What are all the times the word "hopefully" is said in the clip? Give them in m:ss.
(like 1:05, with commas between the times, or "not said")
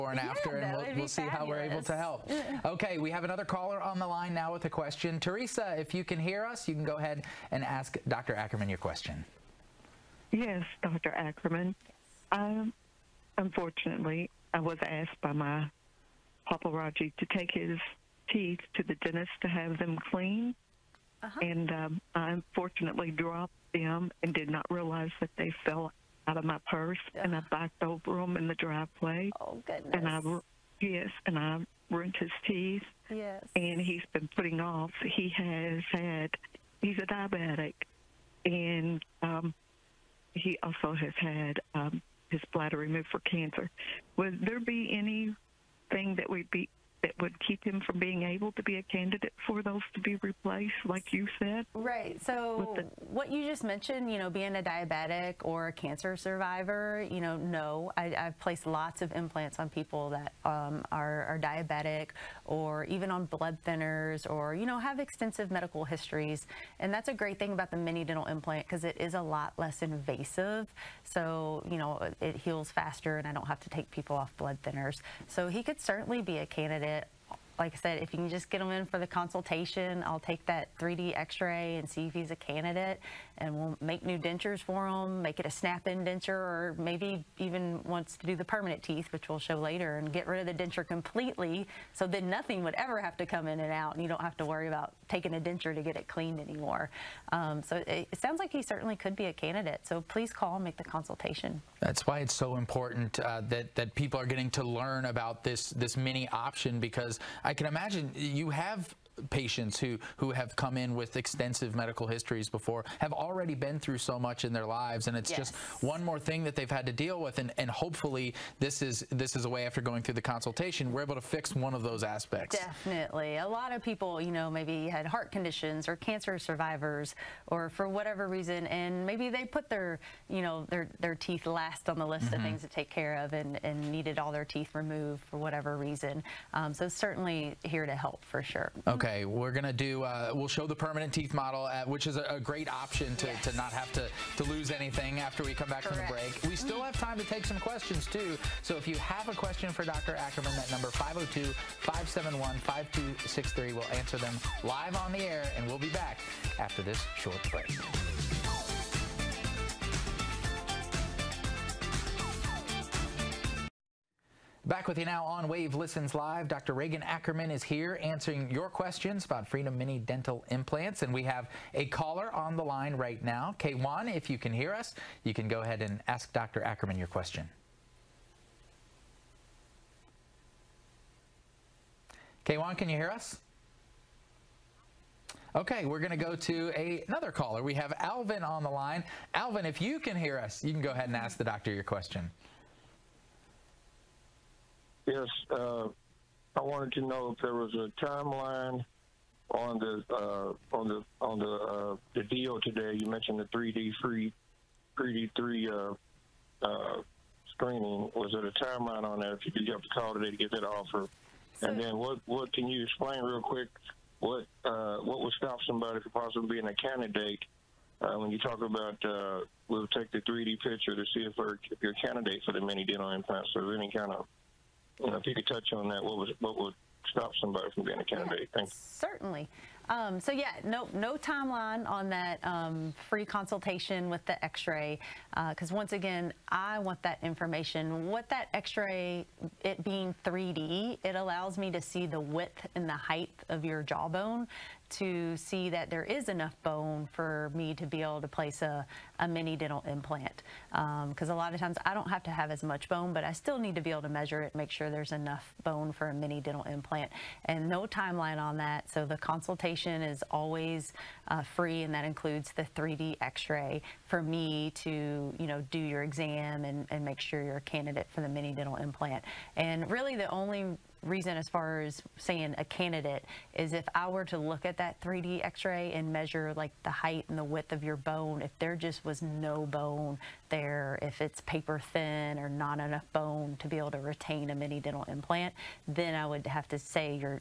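1:57.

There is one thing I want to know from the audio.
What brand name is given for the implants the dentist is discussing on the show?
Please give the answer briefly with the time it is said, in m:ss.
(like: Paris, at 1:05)
Freedom Mini dental implants, at 2:49.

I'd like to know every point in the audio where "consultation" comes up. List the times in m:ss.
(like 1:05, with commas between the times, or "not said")
1:19, 1:40, 2:00, 3:53, 4:19.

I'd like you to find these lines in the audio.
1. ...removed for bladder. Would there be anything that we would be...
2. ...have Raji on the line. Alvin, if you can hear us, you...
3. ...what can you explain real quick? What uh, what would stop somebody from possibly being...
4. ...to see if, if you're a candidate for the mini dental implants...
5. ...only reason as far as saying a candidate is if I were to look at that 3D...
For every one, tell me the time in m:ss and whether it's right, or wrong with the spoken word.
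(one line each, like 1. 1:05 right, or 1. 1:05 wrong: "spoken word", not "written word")
1. 0:42 wrong: "cancer", not "bladder"
2. 3:07 wrong: "Alvin", not "Raji"
3. 3:32 right
4. 3:40 right
5. 4:30 right.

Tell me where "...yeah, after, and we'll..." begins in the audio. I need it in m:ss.
0:00.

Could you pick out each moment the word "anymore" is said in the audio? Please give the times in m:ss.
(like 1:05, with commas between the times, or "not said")
1:36.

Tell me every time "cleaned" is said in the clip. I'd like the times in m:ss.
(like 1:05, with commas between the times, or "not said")
0:20, 1:36.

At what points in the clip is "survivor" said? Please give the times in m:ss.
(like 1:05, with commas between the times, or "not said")
0:56, 2:06.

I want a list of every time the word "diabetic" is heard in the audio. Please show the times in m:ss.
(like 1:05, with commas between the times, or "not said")
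0:37, 0:54, 1:01.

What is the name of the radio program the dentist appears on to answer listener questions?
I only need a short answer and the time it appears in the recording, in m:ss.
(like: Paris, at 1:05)
Wave Listens Live, at 2:45.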